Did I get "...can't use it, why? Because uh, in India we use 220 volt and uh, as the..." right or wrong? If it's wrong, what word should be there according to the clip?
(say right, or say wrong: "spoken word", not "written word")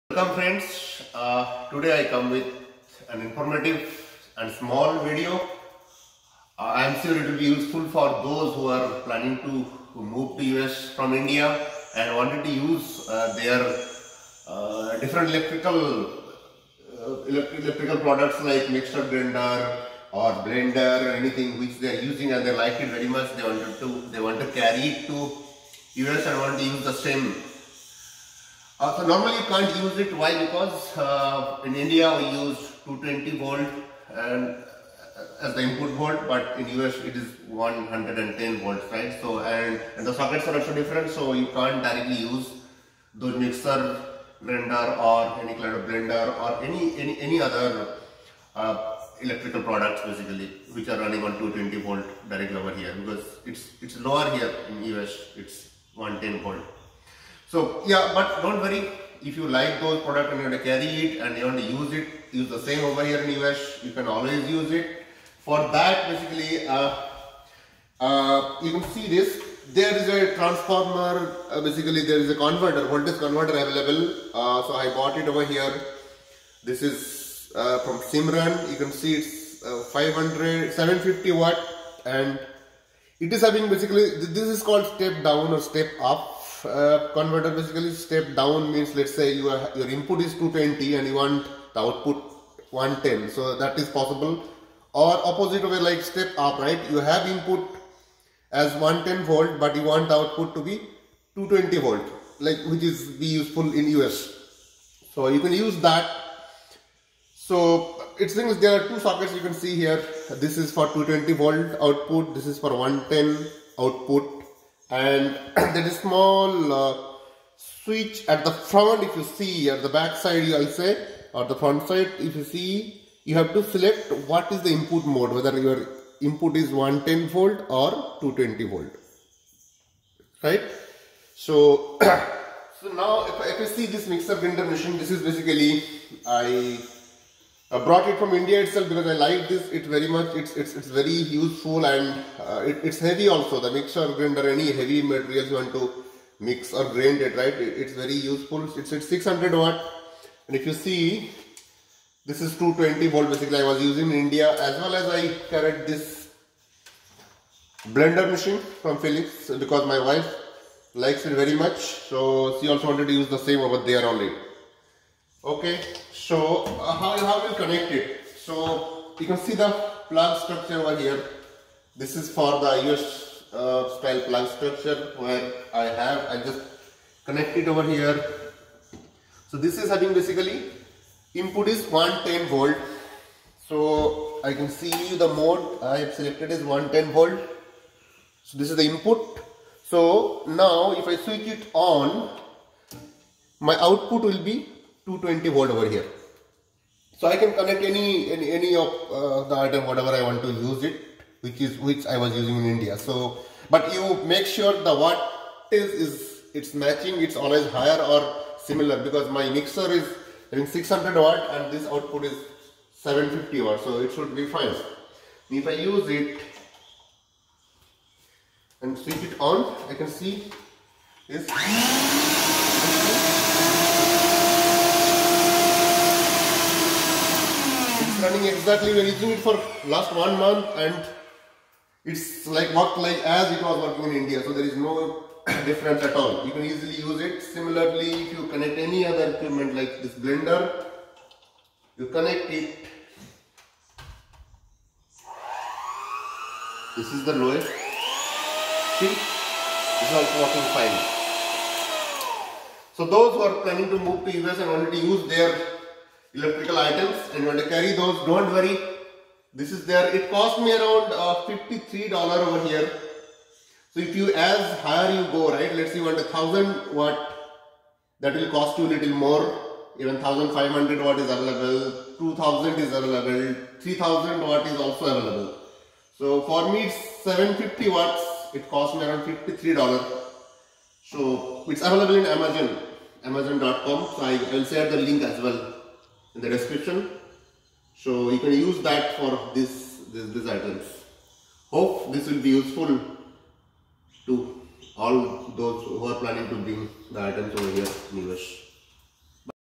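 right.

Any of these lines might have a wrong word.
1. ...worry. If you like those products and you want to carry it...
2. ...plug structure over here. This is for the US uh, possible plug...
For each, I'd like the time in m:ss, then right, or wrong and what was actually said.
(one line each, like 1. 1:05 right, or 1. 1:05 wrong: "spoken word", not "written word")
1. 0:58 right
2. 2:50 wrong: "style", not "possible".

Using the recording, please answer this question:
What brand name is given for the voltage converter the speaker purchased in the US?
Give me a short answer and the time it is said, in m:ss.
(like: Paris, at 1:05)
Simran, at 1:18.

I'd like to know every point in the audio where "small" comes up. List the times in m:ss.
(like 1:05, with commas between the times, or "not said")
0:04, 1:55.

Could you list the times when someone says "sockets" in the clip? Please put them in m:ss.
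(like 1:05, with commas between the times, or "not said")
0:40, 1:48.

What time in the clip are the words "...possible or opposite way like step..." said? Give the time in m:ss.
1:33.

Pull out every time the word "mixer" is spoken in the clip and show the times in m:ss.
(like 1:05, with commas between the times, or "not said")
0:18, 0:43, 2:14, 2:23, 3:29.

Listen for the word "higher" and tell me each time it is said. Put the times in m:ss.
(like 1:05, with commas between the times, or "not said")
3:27, 4:24.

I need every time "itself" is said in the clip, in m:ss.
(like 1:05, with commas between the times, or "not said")
2:18.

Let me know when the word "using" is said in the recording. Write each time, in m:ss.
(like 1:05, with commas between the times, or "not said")
0:22, 2:33, 3:22, 3:49.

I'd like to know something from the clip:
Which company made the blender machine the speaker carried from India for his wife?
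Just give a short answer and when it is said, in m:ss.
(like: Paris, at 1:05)
Philips, at 2:38.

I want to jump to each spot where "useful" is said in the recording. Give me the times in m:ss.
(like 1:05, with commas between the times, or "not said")
0:07, 1:43, 2:21, 2:28, 4:52.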